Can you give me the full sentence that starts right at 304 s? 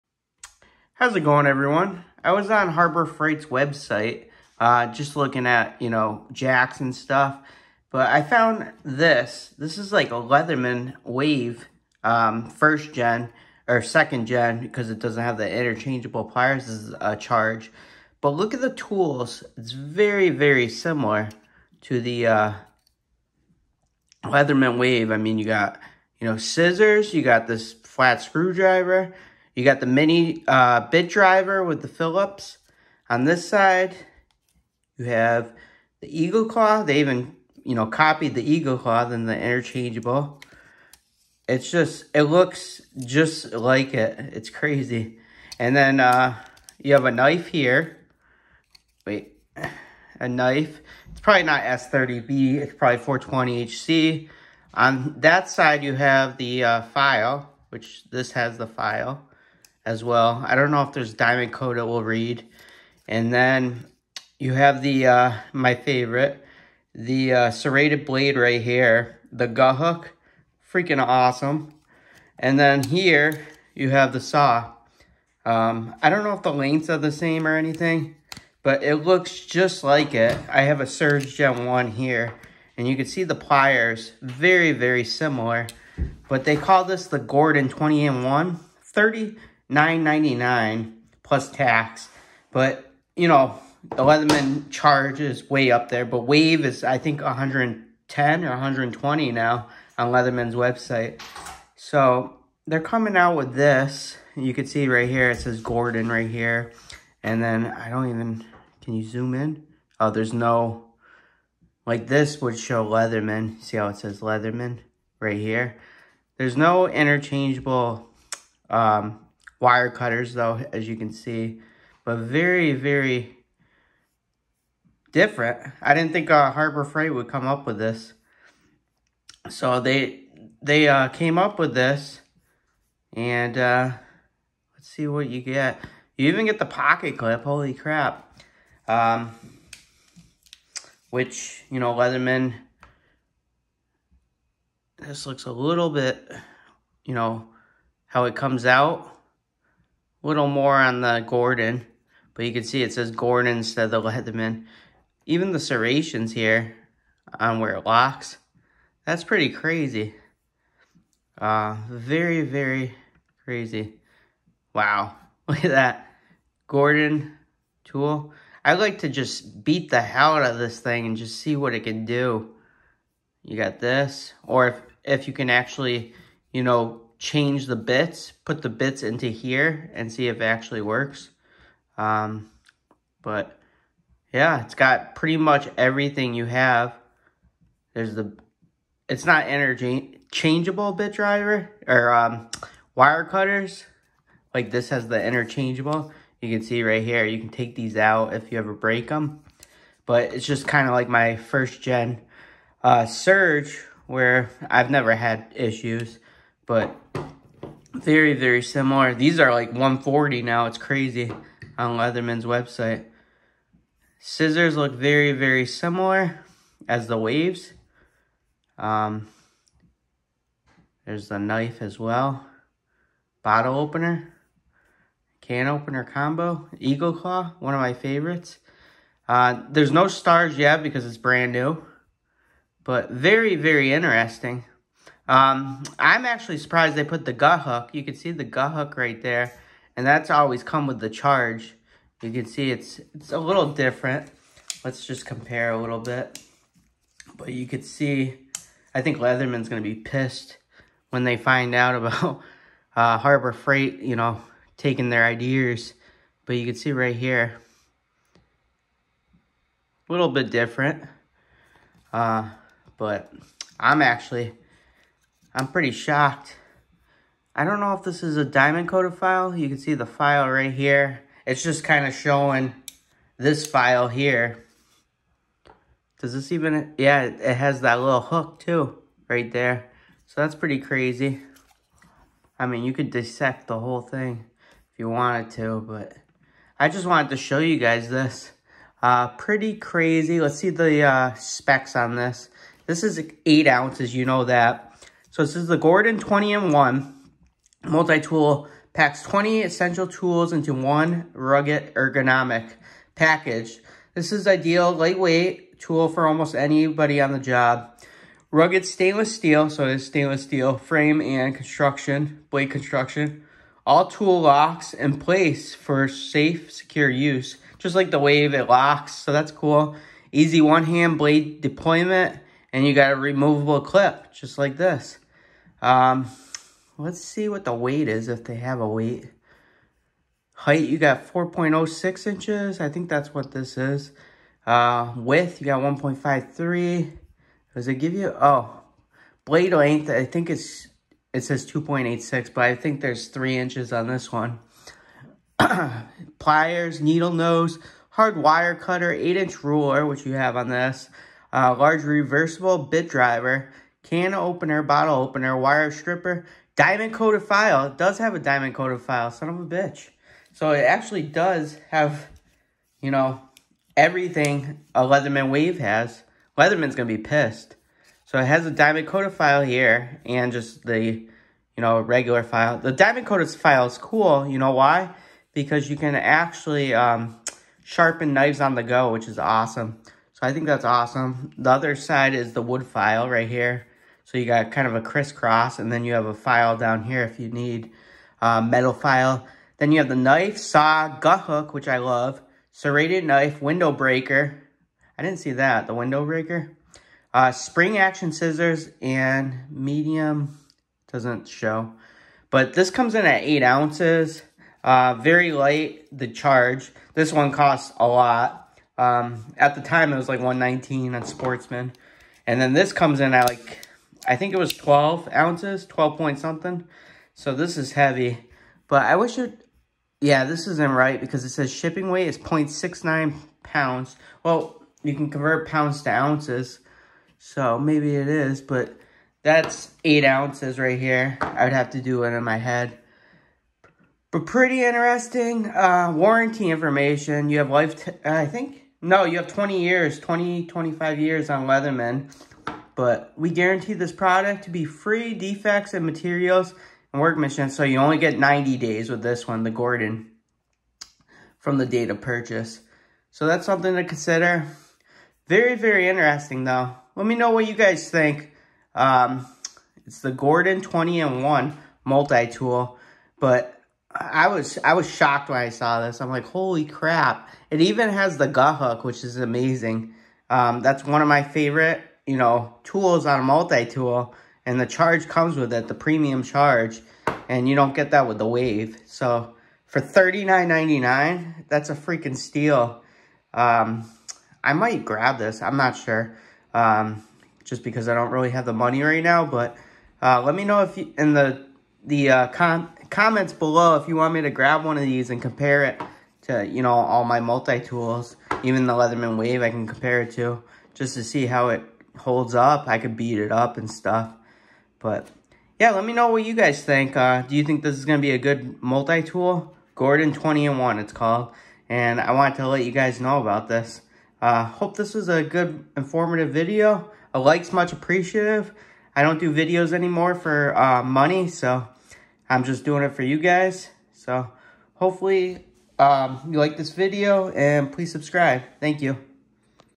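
This is ideal lightweight tool for almost anybody on the job.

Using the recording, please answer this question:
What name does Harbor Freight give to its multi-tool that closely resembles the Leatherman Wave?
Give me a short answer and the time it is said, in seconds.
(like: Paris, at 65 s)
Gordon 20 in 1, at 87 s.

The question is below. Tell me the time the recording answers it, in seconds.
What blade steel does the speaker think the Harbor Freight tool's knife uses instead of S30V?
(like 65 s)
53 s.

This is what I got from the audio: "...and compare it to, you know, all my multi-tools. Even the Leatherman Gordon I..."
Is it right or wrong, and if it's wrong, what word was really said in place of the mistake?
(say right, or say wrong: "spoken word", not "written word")
wrong: "Wave", not "Gordon".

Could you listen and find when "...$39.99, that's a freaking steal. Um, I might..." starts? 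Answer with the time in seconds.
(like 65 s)
479 s.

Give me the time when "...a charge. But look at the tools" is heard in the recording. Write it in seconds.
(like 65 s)
17 s.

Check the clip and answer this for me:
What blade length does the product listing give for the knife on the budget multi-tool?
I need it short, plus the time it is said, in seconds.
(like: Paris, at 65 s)
2.86, at 341 s.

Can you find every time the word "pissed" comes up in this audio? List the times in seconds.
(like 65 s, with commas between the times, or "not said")
249 s, 367 s.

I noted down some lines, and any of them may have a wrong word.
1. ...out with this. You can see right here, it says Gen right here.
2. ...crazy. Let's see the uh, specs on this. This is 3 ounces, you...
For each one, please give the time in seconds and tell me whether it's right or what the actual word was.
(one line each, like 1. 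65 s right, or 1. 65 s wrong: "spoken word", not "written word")
1. 103 s wrong: "Gordon", not "Gen"
2. 289 s wrong: "8", not "3".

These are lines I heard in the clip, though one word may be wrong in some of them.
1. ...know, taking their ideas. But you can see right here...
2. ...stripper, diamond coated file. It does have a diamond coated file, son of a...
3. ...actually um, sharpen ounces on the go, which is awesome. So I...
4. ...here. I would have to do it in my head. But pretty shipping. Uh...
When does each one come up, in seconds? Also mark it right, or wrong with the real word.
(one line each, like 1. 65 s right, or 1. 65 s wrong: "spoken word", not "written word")
1. 254 s right
2. 355 s right
3. 376 s wrong: "knives", not "ounces"
4. 430 s wrong: "interesting", not "shipping".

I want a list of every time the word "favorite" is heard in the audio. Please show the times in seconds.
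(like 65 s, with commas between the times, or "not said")
65 s, 227 s, 471 s.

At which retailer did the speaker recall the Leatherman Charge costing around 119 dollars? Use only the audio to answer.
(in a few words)
Sportsman.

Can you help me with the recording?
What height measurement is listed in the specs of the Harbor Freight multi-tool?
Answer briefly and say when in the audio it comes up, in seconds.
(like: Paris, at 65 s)
4.06 inches, at 331 s.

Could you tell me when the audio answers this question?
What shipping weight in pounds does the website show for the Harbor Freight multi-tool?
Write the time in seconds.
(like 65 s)
422 s.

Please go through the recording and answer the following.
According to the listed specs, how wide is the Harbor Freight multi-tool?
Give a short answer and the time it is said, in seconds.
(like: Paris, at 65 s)
1.53, at 335 s.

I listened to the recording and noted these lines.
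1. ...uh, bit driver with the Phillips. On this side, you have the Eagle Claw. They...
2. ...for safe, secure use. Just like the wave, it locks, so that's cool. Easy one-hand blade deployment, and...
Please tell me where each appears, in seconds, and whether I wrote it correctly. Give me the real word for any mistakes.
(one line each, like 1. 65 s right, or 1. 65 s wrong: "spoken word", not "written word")
1. 30 s right
2. 315 s right.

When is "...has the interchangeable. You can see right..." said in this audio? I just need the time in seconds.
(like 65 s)
194 s.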